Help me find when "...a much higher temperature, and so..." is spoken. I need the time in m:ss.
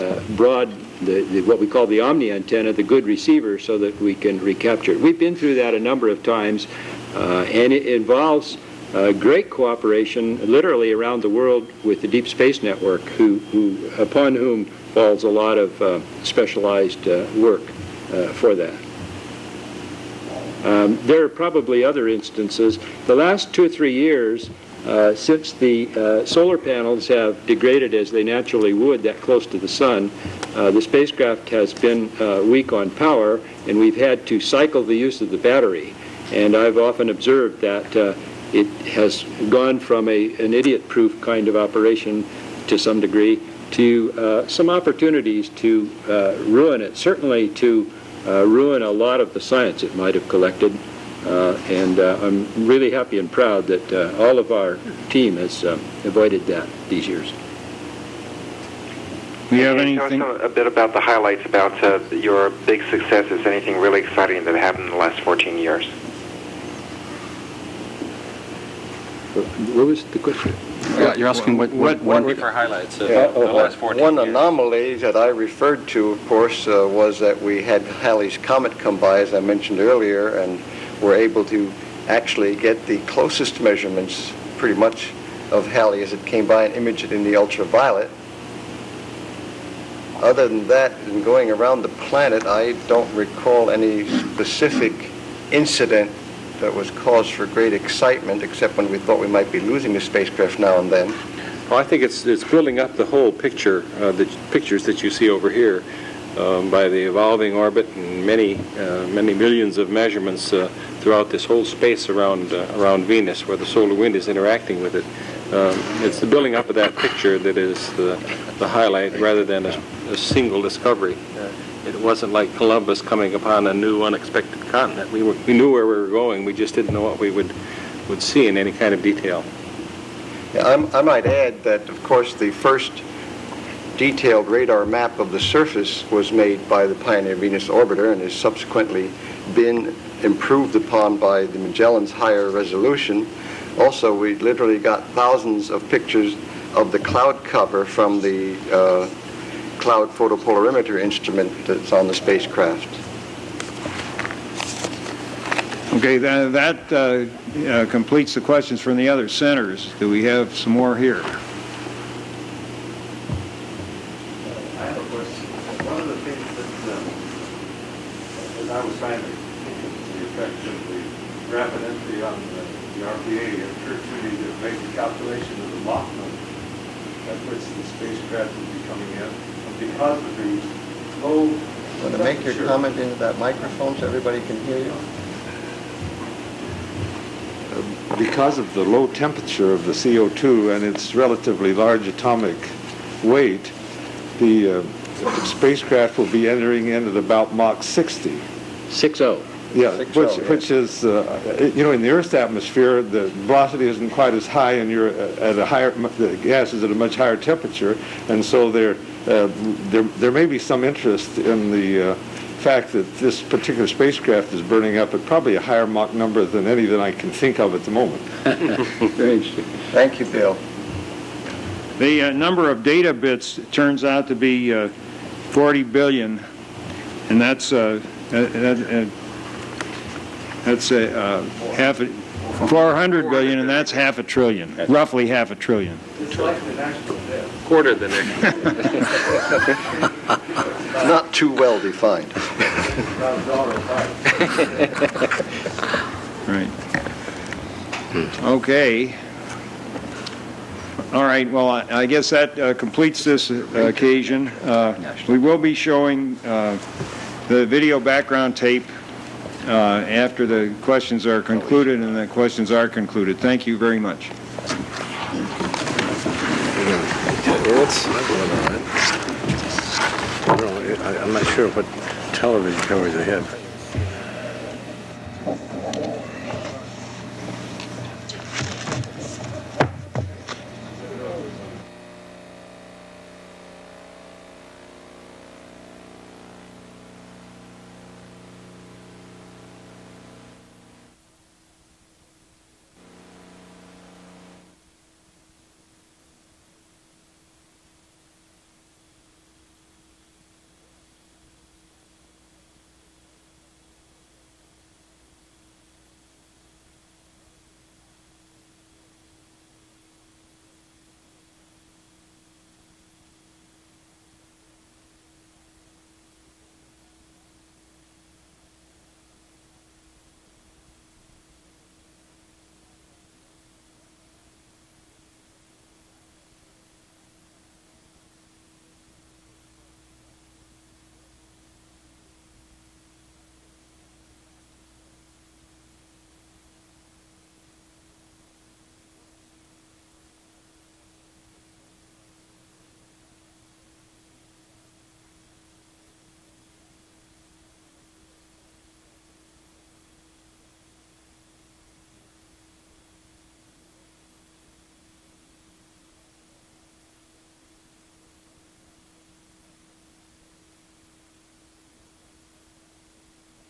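3:26.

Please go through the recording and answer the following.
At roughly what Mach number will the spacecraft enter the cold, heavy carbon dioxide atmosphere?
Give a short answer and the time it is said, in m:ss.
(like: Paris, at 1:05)
Mach 60, at 3:17.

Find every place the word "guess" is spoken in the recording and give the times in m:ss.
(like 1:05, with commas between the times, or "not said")
4:12.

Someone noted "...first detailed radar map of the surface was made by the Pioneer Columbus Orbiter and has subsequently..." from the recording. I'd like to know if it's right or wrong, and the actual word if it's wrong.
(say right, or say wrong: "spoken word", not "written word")
wrong: "Venus", not "Columbus".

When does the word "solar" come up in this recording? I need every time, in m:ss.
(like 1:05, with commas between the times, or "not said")
0:26, 1:53.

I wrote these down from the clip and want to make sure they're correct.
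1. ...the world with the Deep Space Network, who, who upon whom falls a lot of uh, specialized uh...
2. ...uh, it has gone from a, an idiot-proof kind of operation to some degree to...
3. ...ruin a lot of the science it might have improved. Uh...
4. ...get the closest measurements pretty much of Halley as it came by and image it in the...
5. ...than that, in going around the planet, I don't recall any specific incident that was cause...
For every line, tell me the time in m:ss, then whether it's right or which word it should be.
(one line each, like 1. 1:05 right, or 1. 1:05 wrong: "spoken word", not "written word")
1. 0:11 right
2. 0:37 right
3. 0:48 wrong: "collected", not "improved"
4. 1:22 right
5. 1:30 right.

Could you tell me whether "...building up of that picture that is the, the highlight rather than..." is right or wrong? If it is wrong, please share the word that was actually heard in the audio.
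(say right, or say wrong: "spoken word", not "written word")
right.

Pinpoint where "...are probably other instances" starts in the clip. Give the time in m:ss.
0:21.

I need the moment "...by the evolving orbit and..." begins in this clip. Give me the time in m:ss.
1:46.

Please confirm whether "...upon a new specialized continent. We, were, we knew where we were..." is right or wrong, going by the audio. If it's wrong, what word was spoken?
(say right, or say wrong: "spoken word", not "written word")
wrong: "unexpected", not "specialized".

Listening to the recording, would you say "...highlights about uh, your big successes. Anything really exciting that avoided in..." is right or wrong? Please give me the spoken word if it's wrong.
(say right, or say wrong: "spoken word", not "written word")
wrong: "happened", not "avoided".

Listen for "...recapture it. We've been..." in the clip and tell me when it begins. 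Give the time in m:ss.
0:04.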